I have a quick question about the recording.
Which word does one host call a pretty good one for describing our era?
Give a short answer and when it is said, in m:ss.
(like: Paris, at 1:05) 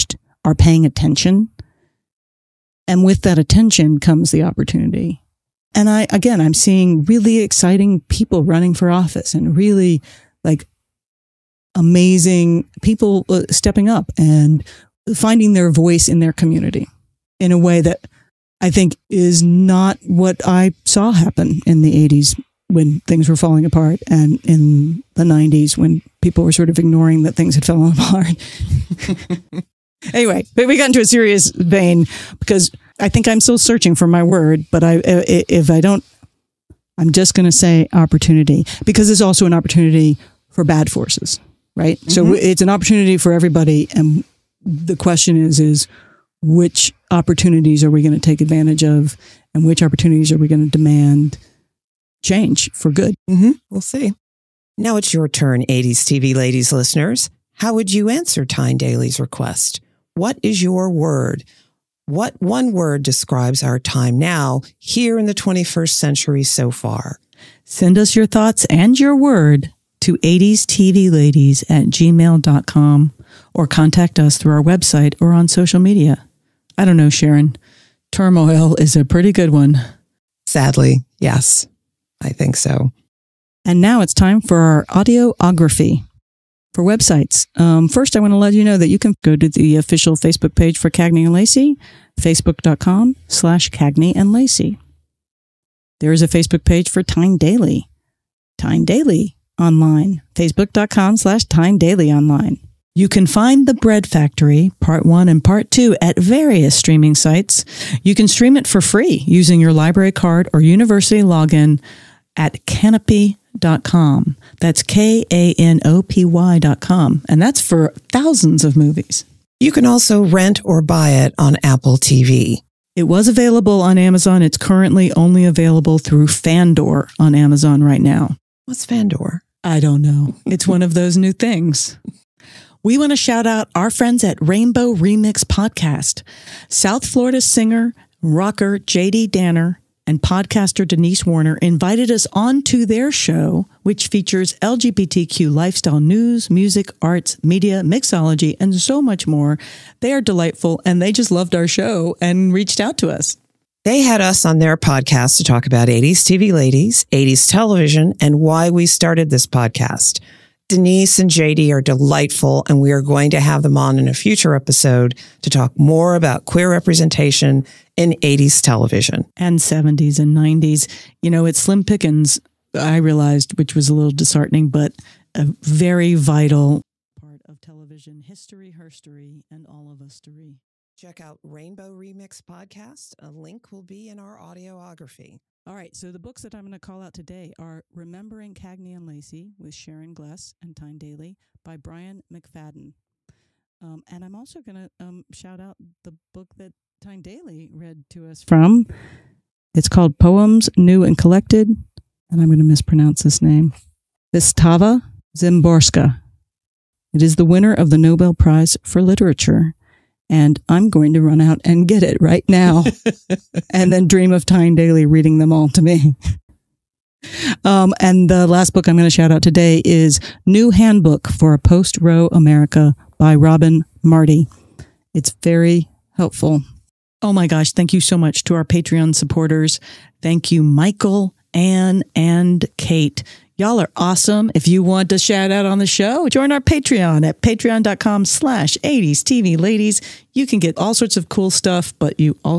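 Turmoil, at 1:18.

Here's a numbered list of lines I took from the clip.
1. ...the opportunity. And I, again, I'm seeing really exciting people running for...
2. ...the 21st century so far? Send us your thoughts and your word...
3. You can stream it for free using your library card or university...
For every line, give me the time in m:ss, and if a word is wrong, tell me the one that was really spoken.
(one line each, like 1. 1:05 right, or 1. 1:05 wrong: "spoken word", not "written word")
1. 0:04 right
2. 1:05 right
3. 1:48 right.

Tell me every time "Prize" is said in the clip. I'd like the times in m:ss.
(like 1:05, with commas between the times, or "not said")
3:28.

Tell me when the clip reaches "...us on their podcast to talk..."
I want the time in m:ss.
2:34.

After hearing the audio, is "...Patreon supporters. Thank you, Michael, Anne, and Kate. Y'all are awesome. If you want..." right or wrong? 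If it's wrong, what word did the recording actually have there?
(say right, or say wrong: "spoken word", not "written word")
right.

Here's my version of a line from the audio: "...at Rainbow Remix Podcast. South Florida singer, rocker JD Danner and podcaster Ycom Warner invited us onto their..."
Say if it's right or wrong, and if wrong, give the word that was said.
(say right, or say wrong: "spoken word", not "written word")
wrong: "Denise", not "Ycom".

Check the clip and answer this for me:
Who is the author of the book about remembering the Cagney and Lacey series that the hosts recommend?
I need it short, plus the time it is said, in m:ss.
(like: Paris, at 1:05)
Brian McFadden, at 3:11.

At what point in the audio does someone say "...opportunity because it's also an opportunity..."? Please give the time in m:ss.
0:37.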